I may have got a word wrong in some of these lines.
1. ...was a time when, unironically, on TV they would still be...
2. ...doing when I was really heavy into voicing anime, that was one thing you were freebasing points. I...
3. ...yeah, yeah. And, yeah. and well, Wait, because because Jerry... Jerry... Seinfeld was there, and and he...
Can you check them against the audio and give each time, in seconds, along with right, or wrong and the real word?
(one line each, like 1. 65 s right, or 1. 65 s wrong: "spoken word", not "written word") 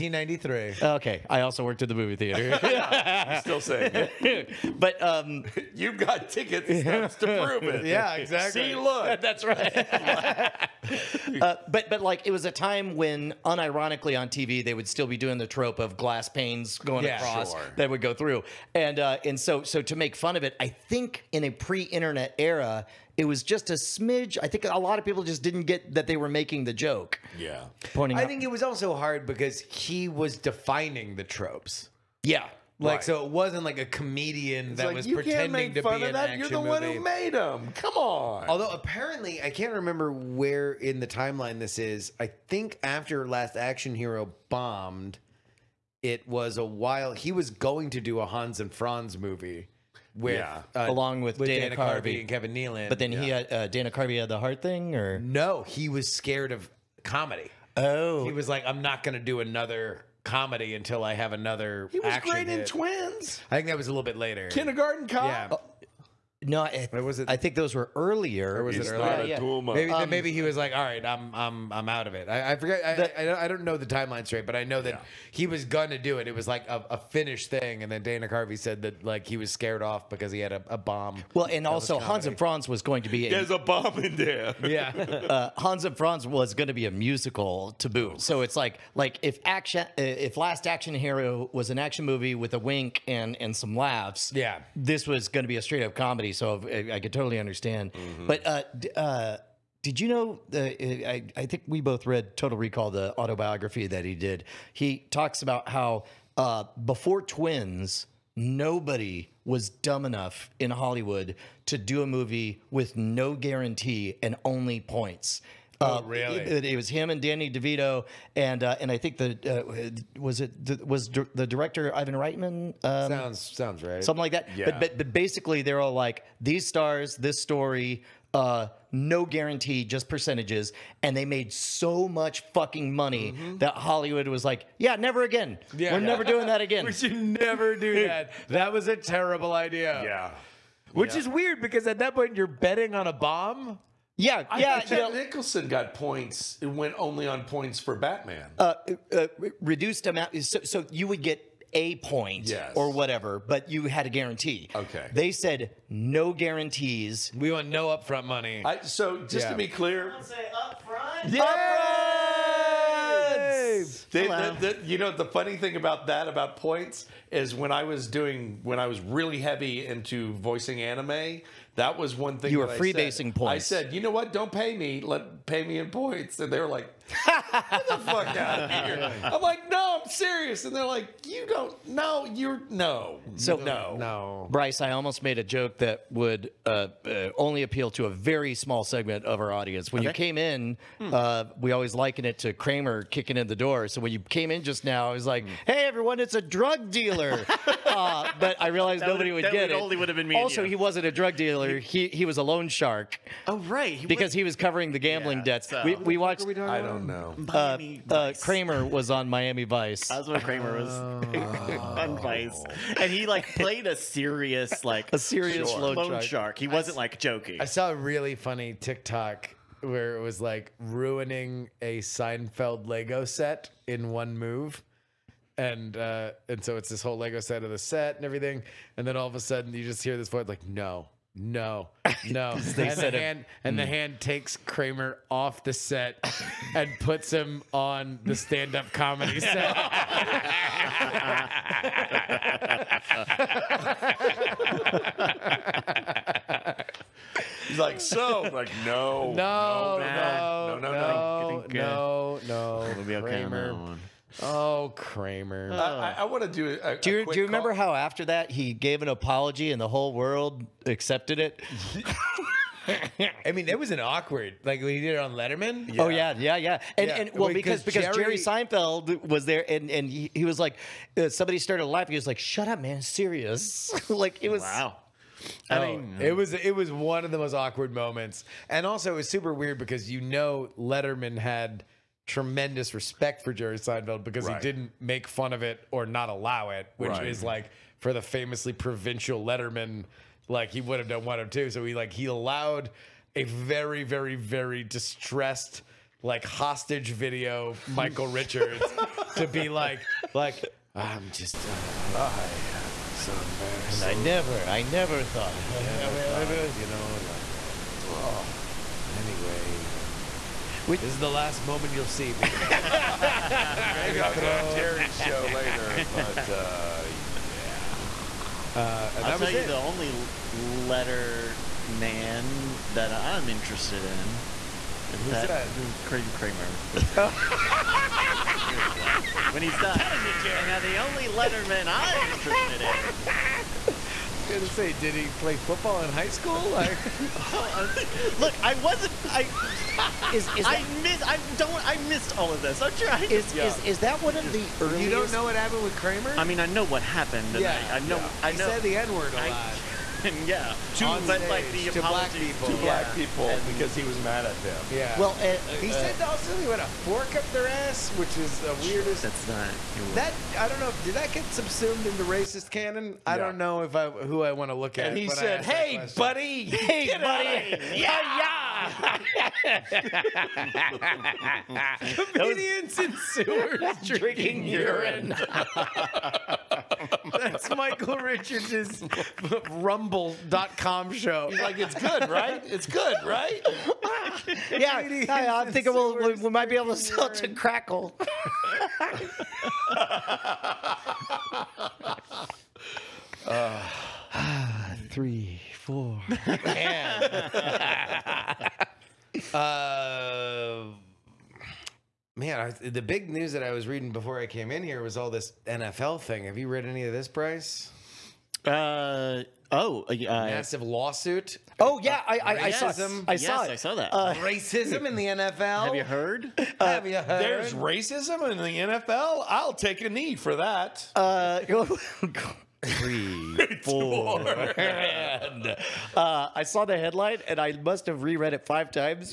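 1. 12 s right
2. 168 s right
3. 266 s right.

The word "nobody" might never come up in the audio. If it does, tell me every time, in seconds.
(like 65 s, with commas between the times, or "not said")
108 s, 199 s.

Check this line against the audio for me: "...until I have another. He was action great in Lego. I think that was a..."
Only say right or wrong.
wrong.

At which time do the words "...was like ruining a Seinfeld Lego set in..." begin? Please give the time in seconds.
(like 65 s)
220 s.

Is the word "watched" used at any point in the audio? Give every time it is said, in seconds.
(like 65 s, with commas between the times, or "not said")
206 s.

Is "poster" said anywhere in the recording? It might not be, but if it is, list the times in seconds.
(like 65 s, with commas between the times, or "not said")
not said.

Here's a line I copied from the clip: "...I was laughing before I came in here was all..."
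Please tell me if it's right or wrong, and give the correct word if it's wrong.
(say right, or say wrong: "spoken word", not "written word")
wrong: "reading", not "laughing".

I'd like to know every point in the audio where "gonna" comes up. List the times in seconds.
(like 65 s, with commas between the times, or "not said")
75 s, 334 s.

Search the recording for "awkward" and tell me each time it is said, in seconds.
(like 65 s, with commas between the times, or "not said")
263 s, 277 s.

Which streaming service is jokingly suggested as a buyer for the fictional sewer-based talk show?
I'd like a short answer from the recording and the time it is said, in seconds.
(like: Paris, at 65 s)
Crackle, at 387 s.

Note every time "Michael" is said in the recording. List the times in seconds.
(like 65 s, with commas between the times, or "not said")
297 s, 377 s.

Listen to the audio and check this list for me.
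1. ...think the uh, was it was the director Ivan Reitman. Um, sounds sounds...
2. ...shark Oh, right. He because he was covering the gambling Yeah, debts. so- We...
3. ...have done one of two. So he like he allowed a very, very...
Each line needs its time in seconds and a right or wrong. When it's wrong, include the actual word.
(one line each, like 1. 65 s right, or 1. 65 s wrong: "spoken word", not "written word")
1. 118 s right
2. 202 s right
3. 290 s right.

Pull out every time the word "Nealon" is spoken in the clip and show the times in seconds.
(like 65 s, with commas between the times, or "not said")
52 s.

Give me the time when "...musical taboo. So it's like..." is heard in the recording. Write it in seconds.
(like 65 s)
86 s.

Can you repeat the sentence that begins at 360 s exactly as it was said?
Did that get subsumed into racist canon?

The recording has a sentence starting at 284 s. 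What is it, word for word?
he didn't make fun of it or not allow it, which right.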